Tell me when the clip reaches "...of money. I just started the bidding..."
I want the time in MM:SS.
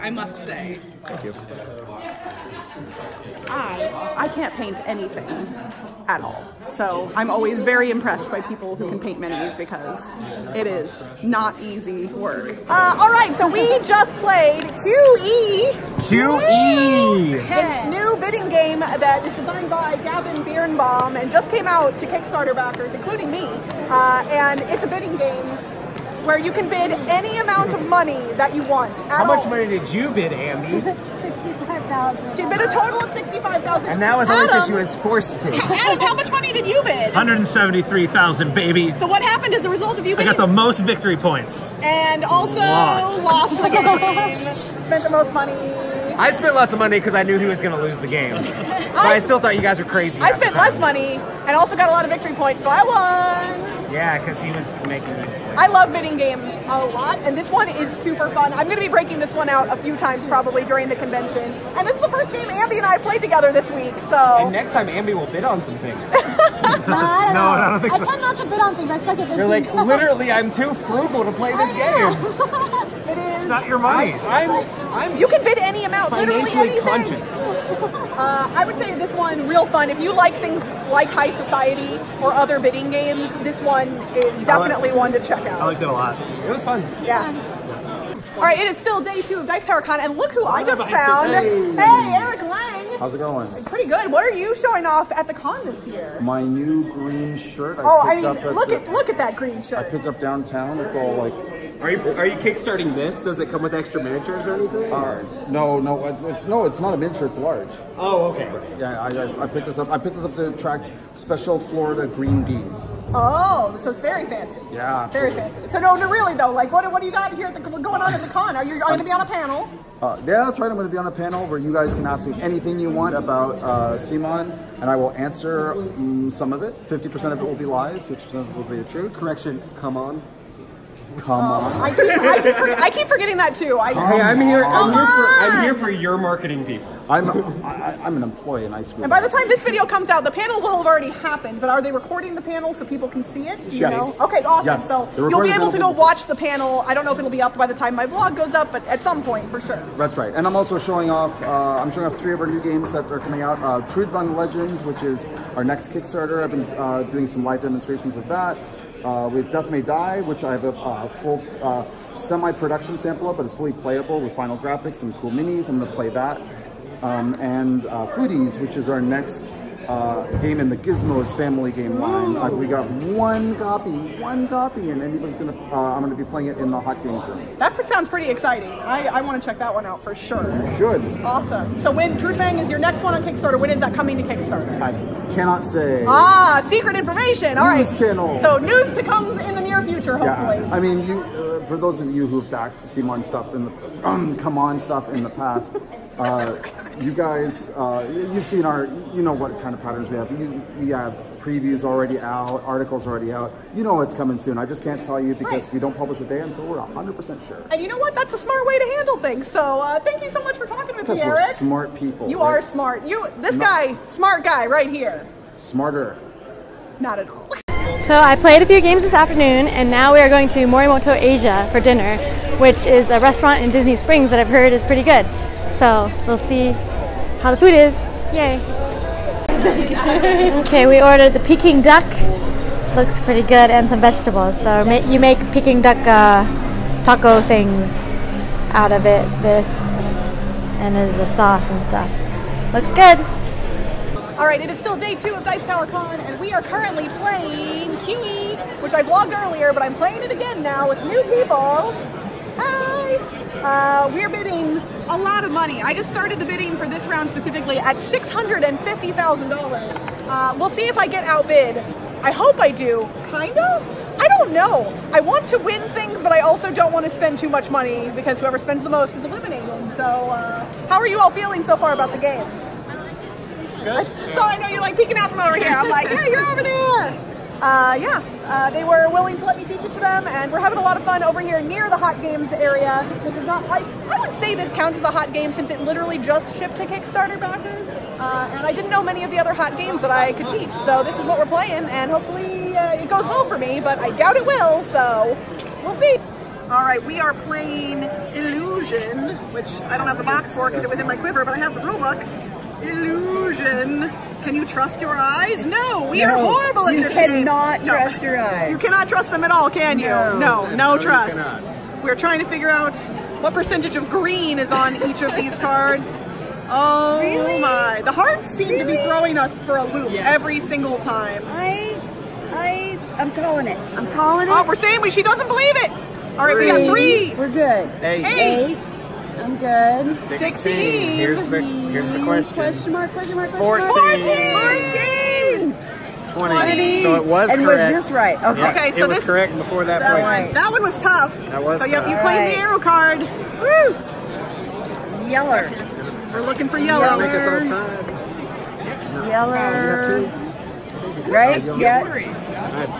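04:15.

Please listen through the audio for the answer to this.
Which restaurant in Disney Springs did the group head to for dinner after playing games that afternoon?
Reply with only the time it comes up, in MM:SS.
03:40.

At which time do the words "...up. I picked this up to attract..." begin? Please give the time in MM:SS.
01:49.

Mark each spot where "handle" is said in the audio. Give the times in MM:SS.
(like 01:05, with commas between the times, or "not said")
03:28.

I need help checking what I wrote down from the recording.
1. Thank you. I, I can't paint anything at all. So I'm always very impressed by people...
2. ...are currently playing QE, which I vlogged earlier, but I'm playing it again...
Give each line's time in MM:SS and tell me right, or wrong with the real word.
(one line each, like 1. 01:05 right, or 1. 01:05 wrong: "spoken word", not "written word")
1. 00:01 right
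2. 04:06 right.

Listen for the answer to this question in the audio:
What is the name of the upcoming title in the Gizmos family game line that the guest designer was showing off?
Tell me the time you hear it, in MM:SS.
02:48.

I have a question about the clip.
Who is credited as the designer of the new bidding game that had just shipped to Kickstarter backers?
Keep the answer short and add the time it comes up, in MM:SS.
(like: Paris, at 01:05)
Gavin Birnbaum, at 00:20.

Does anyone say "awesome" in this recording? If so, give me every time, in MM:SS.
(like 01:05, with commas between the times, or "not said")
02:24, 03:01.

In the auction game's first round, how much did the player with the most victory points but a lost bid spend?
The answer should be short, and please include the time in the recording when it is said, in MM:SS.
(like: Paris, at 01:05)
173000, at 00:37.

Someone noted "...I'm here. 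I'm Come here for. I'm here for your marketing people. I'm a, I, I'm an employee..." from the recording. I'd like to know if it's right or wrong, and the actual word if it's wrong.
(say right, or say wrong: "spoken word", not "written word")
right.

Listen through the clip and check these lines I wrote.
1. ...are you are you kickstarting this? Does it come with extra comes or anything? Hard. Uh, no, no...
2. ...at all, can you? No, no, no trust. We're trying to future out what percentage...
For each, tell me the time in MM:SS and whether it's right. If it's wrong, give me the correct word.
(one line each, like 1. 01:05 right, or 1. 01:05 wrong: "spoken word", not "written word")
1. 01:41 wrong: "miniatures", not "comes"
2. 05:09 wrong: "figure", not "future".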